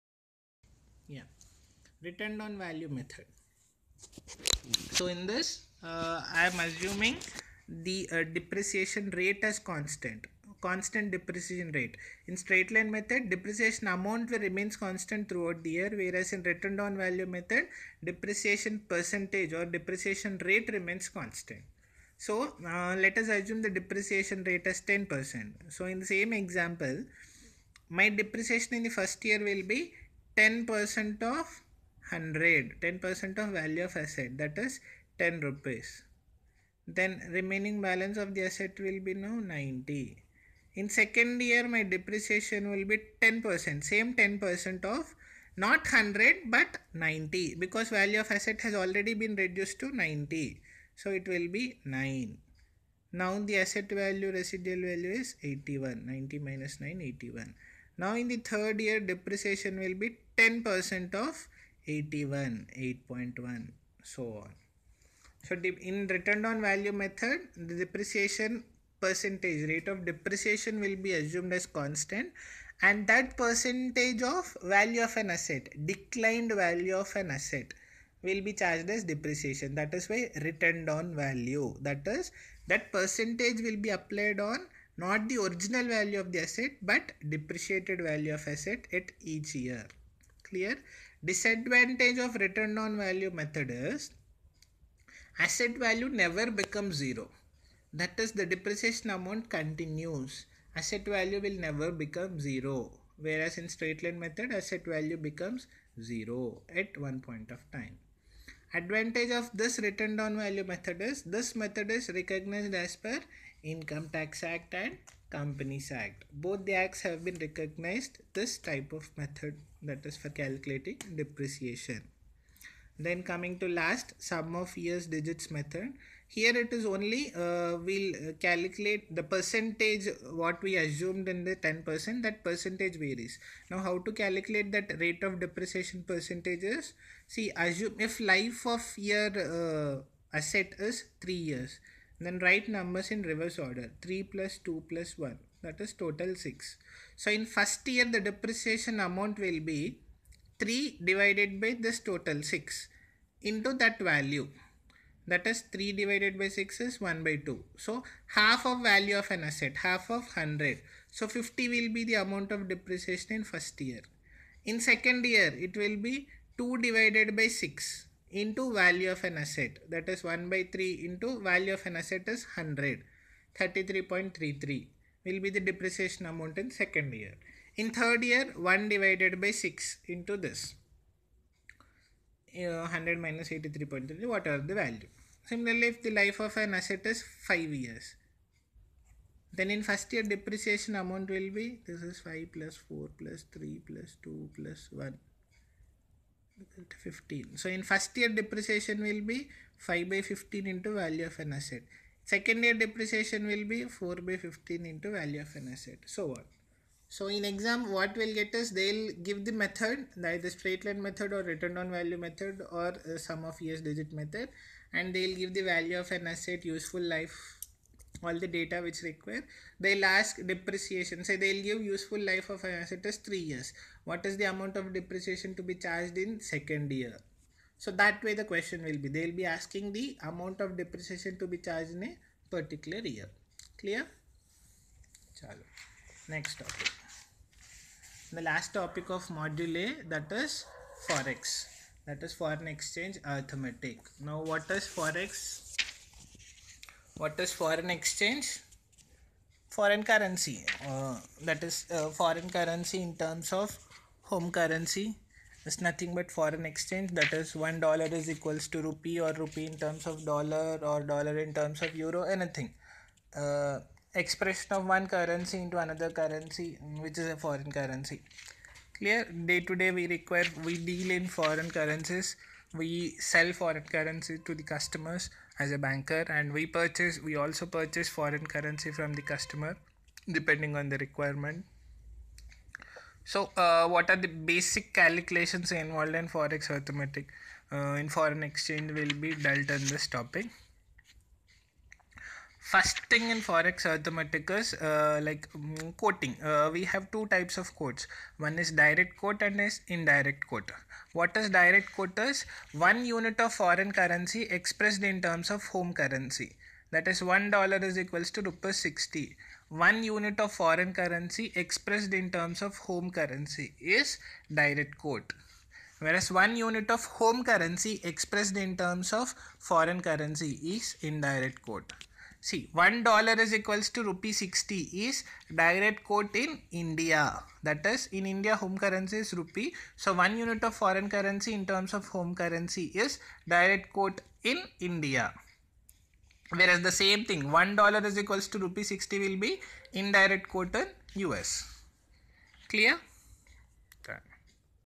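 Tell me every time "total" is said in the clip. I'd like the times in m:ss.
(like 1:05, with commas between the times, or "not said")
2:25, 2:31.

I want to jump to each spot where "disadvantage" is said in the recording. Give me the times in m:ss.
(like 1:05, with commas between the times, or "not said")
1:31.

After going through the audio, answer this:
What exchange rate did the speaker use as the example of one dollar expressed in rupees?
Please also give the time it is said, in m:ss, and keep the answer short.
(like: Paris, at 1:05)
60 rupees, at 5:08.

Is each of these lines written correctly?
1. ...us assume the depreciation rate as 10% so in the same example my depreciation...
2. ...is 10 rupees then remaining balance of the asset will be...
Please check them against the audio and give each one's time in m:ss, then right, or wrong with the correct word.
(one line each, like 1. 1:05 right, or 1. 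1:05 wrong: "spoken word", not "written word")
1. 0:23 right
2. 0:34 right.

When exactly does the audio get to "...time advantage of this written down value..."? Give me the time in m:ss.
1:47.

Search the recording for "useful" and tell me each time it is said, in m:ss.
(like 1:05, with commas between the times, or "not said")
3:36, 3:41.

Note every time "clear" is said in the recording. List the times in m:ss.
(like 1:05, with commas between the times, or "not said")
1:30, 3:53, 4:28, 5:42.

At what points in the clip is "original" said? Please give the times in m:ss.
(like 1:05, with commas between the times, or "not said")
1:25.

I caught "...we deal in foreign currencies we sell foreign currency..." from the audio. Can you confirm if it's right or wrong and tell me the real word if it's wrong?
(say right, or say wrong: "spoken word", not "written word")
right.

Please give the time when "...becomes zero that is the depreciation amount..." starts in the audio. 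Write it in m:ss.
1:36.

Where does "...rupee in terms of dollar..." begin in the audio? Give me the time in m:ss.
4:19.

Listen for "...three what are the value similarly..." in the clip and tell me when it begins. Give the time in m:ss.
3:04.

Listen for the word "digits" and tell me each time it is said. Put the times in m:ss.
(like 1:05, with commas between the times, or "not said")
2:05, 3:33.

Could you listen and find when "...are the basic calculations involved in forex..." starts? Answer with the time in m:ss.
4:44.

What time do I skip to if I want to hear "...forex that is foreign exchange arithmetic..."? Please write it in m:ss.
4:01.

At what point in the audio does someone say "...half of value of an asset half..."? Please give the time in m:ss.
2:38.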